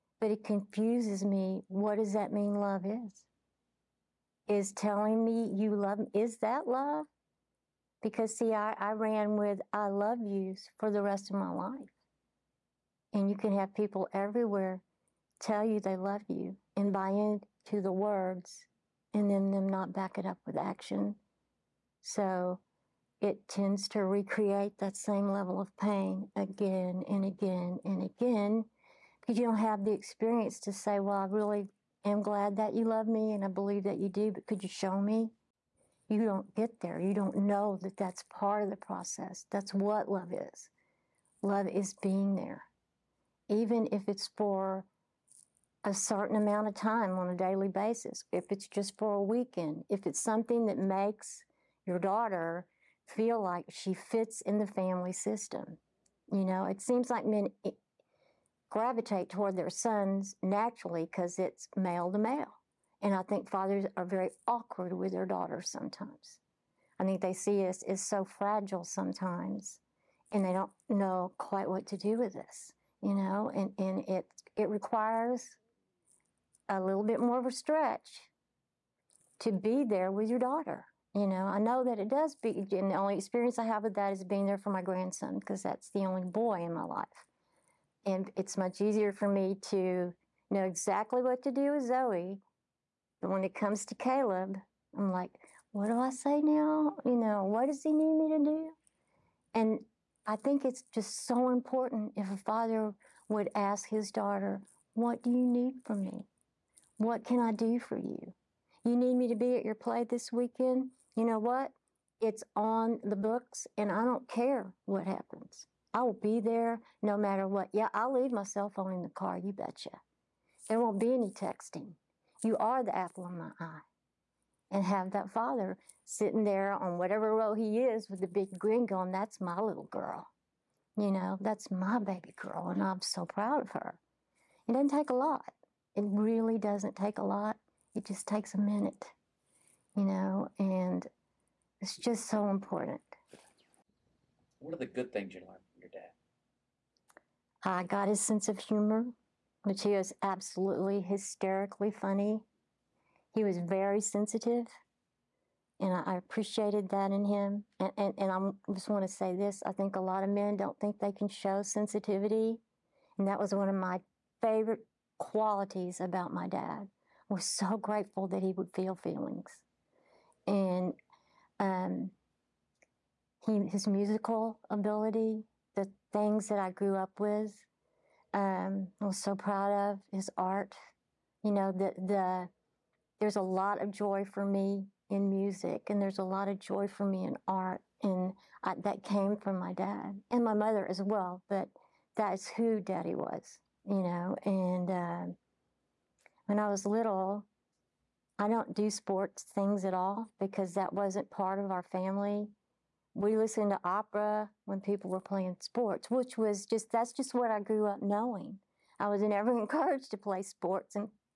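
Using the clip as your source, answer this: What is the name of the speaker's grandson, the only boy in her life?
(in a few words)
Caleb.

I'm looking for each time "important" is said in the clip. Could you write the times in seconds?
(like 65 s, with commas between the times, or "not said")
101 s, 142 s.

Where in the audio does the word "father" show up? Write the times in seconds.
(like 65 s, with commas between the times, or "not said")
63 s, 102 s, 125 s.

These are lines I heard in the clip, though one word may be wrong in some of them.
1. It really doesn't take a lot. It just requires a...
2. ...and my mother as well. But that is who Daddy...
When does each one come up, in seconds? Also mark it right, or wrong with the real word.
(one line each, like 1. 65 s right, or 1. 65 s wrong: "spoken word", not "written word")
1. 135 s wrong: "takes", not "requires"
2. 190 s right.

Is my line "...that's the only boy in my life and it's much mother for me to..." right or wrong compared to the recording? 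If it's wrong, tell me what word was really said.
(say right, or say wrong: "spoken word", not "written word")
wrong: "easier", not "mother".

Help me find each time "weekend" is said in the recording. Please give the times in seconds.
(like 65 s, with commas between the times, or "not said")
49 s, 110 s.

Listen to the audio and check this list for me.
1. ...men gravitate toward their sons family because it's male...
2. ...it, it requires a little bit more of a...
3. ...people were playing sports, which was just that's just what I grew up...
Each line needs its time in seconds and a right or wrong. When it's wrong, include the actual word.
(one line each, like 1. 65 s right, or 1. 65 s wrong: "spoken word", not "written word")
1. 57 s wrong: "naturally", not "family"
2. 74 s right
3. 204 s right.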